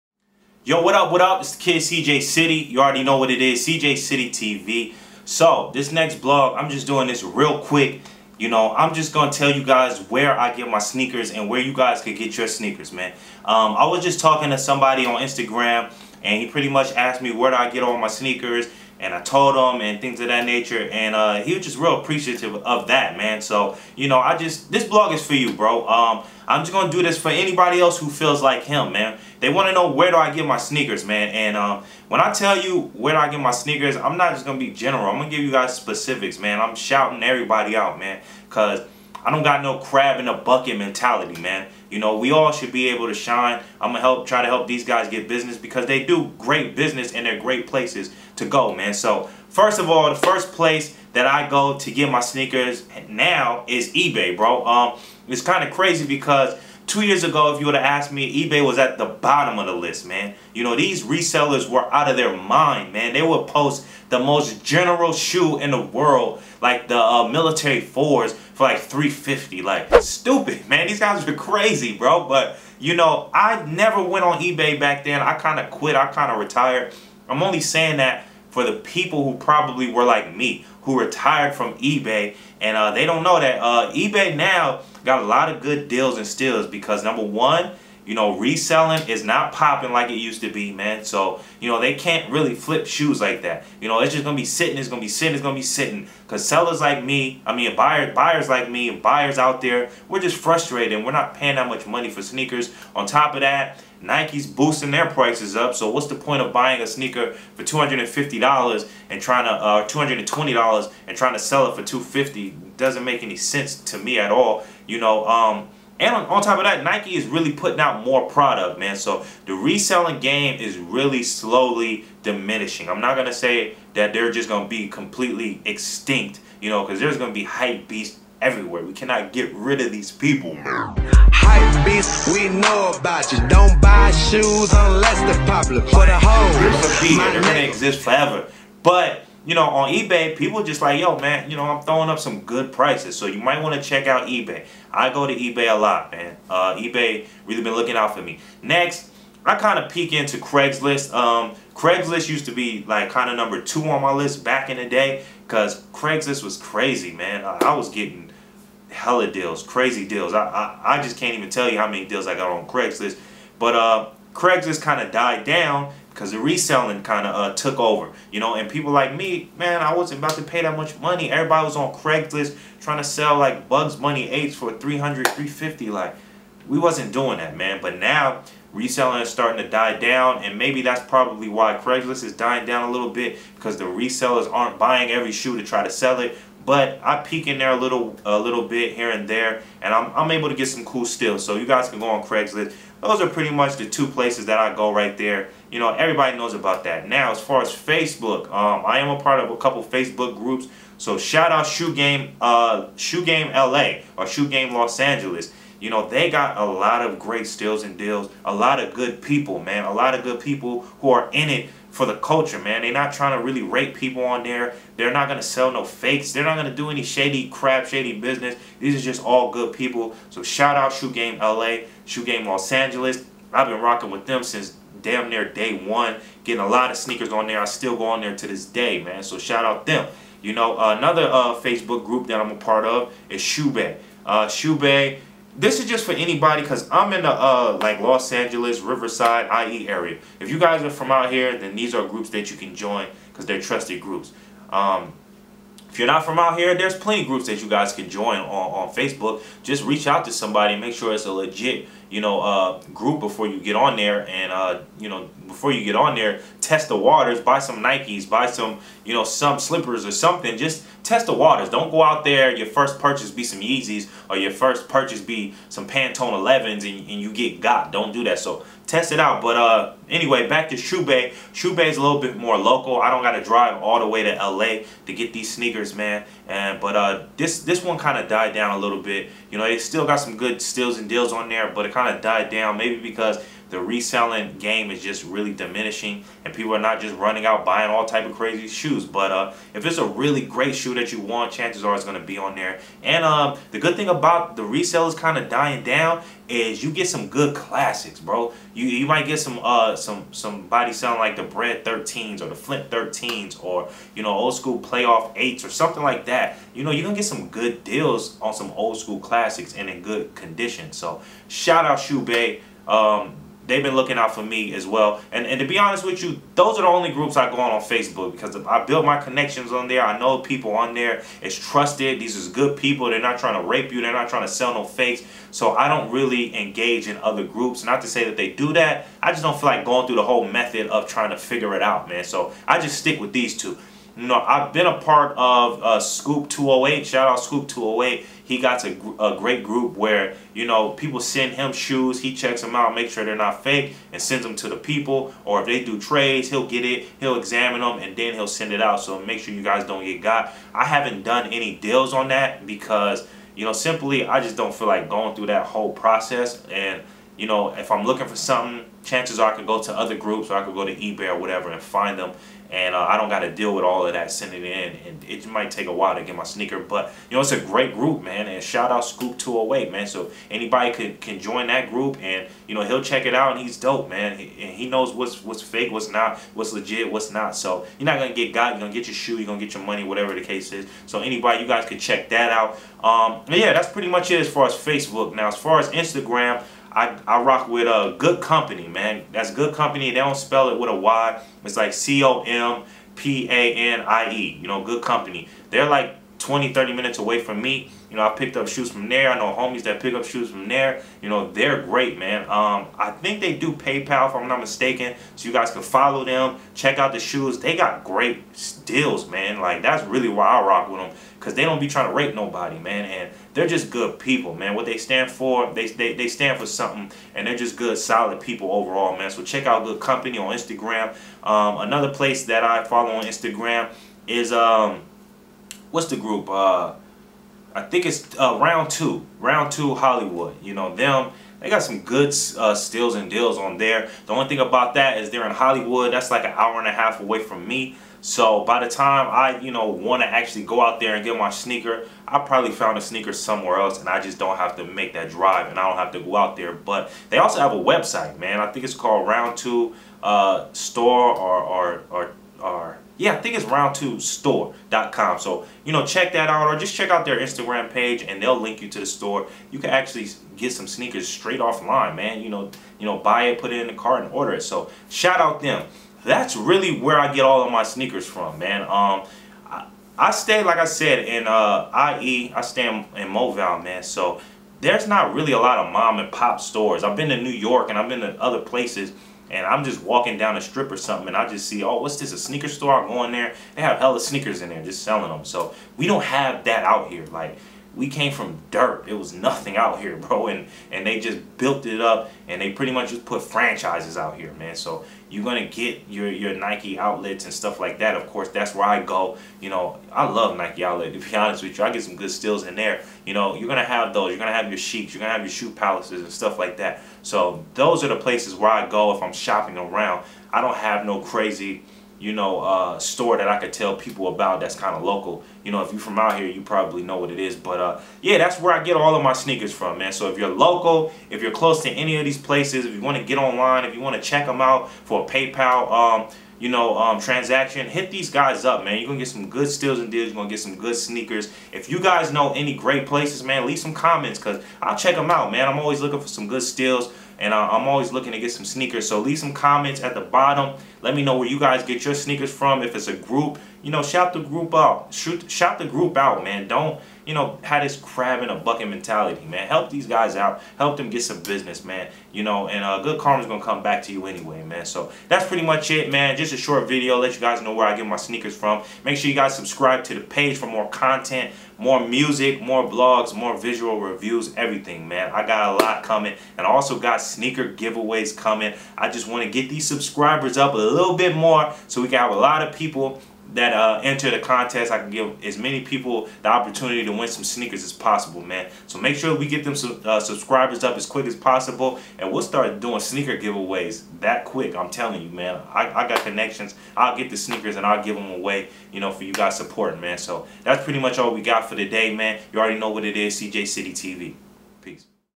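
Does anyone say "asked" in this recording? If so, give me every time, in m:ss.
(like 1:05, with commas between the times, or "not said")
0:16, 0:57.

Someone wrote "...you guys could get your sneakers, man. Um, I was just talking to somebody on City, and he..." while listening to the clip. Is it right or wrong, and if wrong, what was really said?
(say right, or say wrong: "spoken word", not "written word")
wrong: "Instagram", not "City".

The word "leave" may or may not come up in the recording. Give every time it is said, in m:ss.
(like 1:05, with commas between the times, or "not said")
8:53, 8:59.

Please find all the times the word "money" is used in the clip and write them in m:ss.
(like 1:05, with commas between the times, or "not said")
1:41, 2:50, 6:19.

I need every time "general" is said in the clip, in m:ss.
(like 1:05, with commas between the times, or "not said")
0:34, 1:04.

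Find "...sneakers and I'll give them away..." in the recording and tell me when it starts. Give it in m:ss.
9:47.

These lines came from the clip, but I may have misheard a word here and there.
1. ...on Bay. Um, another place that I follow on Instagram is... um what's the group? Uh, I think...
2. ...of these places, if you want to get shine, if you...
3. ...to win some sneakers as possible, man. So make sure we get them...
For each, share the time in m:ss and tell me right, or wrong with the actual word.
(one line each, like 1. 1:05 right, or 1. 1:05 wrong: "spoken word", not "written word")
1. 7:00 wrong: "Instagram", not "Bay"
2. 8:42 wrong: "online", not "shine"
3. 9:37 right.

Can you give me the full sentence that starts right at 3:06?
But I peek in there a little, a little bit here and there, and I'm, I'm able to get some cool steals.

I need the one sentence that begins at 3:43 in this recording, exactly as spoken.
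I've been rocking with them since damn near day one.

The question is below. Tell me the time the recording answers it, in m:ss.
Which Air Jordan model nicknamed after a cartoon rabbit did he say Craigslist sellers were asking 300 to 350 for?
2:53.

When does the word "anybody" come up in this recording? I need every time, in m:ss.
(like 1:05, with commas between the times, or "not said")
0:27, 3:56, 6:10, 6:21.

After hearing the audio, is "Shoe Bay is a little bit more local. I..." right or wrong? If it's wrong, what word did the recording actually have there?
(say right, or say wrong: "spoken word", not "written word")
right.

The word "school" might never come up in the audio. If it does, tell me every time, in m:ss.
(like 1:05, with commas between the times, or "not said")
5:04, 5:08.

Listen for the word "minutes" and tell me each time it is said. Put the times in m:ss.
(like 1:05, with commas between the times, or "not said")
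6:36.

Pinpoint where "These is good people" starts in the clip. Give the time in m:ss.
5:22.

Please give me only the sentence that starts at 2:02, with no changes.
I'm not going to say that they're just going to be completely extinct, you know, because there's going to be hype everywhere.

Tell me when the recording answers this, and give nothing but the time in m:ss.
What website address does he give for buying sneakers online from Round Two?
7:33.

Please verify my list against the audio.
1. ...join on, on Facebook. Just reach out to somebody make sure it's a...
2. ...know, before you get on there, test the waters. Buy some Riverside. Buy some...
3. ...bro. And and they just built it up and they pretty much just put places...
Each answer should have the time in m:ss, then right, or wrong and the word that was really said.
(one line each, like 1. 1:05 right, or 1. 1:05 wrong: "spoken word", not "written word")
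1. 4:08 right
2. 4:15 wrong: "Nikes", not "Riverside"
3. 8:10 wrong: "franchises", not "places".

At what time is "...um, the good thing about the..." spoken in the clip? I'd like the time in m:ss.
4:53.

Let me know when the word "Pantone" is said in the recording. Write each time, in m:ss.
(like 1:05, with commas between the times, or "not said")
4:25.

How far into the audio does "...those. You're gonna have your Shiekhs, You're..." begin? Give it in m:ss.
8:24.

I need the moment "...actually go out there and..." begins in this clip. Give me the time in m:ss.
7:20.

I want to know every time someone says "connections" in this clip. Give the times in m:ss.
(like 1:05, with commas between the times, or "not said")
5:19, 9:46.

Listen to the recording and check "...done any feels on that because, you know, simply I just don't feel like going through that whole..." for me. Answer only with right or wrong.
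wrong.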